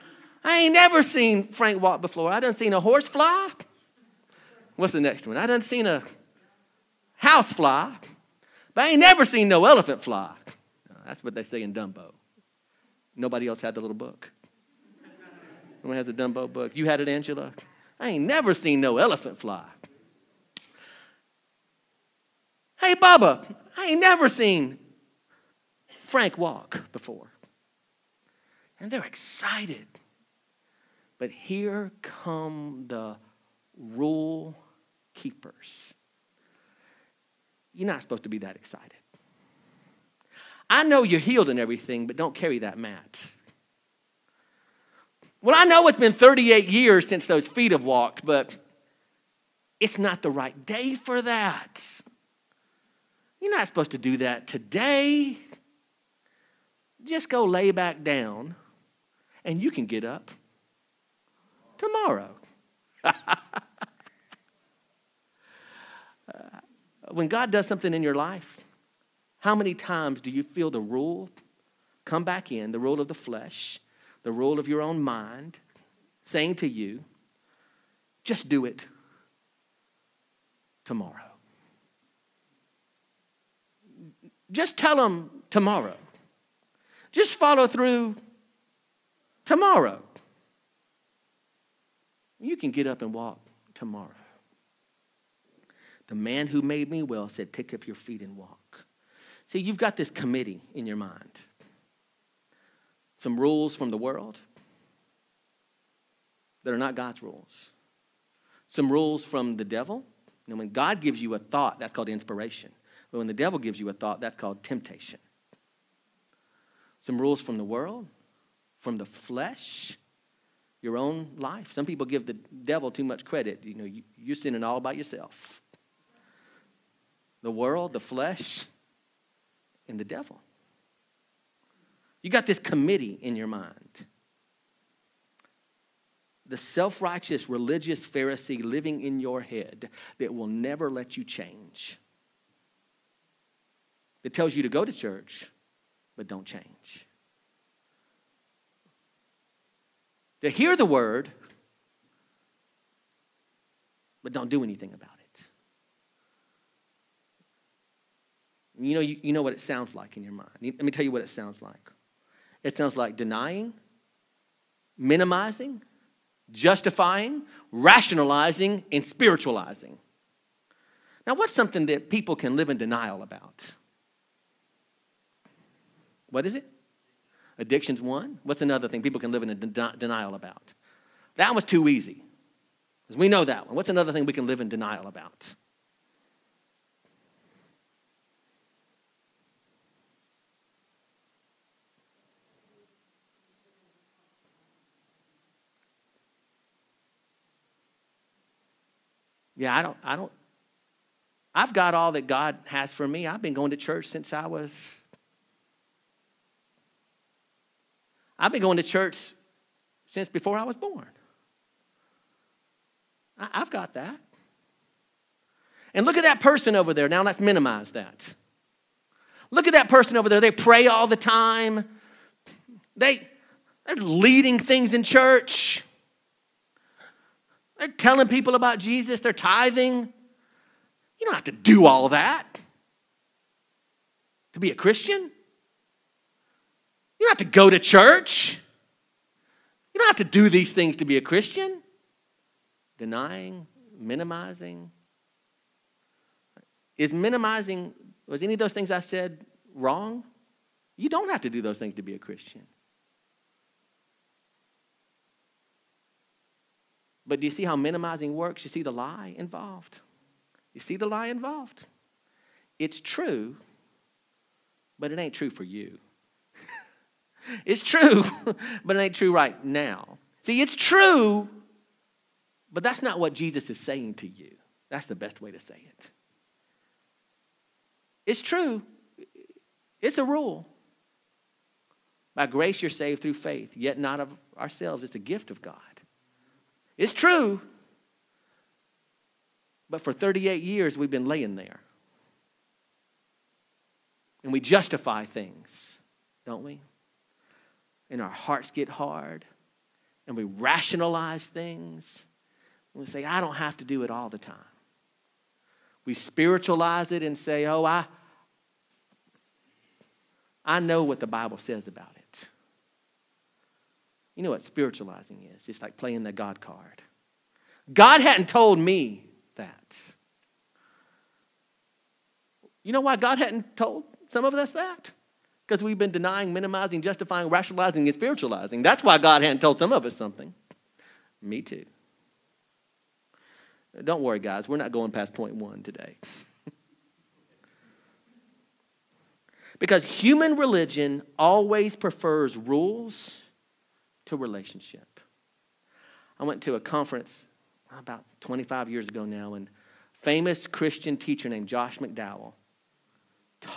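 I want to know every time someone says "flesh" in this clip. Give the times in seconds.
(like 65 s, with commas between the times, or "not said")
73 s, 119 s, 127 s.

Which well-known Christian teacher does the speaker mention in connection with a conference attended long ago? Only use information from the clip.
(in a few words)
Josh McDowell.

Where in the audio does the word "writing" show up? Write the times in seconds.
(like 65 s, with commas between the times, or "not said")
not said.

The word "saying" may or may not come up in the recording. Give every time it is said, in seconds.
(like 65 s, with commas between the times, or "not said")
76 s, 273 s.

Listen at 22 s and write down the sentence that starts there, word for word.
Hey, Bubba, I ain't never seen Frank walk before.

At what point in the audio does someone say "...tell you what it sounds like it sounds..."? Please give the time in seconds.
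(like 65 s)
160 s.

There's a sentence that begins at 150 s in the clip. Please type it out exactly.
To hear the word, but don't do anything about it.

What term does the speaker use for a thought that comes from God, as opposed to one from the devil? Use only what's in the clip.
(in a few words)
Inspiration.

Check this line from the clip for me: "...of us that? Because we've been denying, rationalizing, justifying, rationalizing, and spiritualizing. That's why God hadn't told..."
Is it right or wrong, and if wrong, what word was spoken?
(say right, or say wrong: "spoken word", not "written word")
wrong: "minimizing", not "rationalizing".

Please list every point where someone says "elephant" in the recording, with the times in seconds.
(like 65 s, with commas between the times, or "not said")
9 s, 18 s.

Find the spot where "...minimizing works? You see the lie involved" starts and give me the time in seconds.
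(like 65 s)
257 s.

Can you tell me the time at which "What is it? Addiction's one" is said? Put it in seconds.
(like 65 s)
176 s.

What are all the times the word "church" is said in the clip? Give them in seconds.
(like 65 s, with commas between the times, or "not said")
144 s, 203 s, 208 s, 225 s, 237 s.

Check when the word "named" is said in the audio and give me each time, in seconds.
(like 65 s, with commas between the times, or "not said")
351 s.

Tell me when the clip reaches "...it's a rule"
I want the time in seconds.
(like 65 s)
280 s.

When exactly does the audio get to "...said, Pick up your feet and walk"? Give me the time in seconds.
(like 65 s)
97 s.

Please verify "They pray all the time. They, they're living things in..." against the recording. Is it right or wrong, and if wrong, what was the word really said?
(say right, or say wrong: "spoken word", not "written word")
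wrong: "leading", not "living".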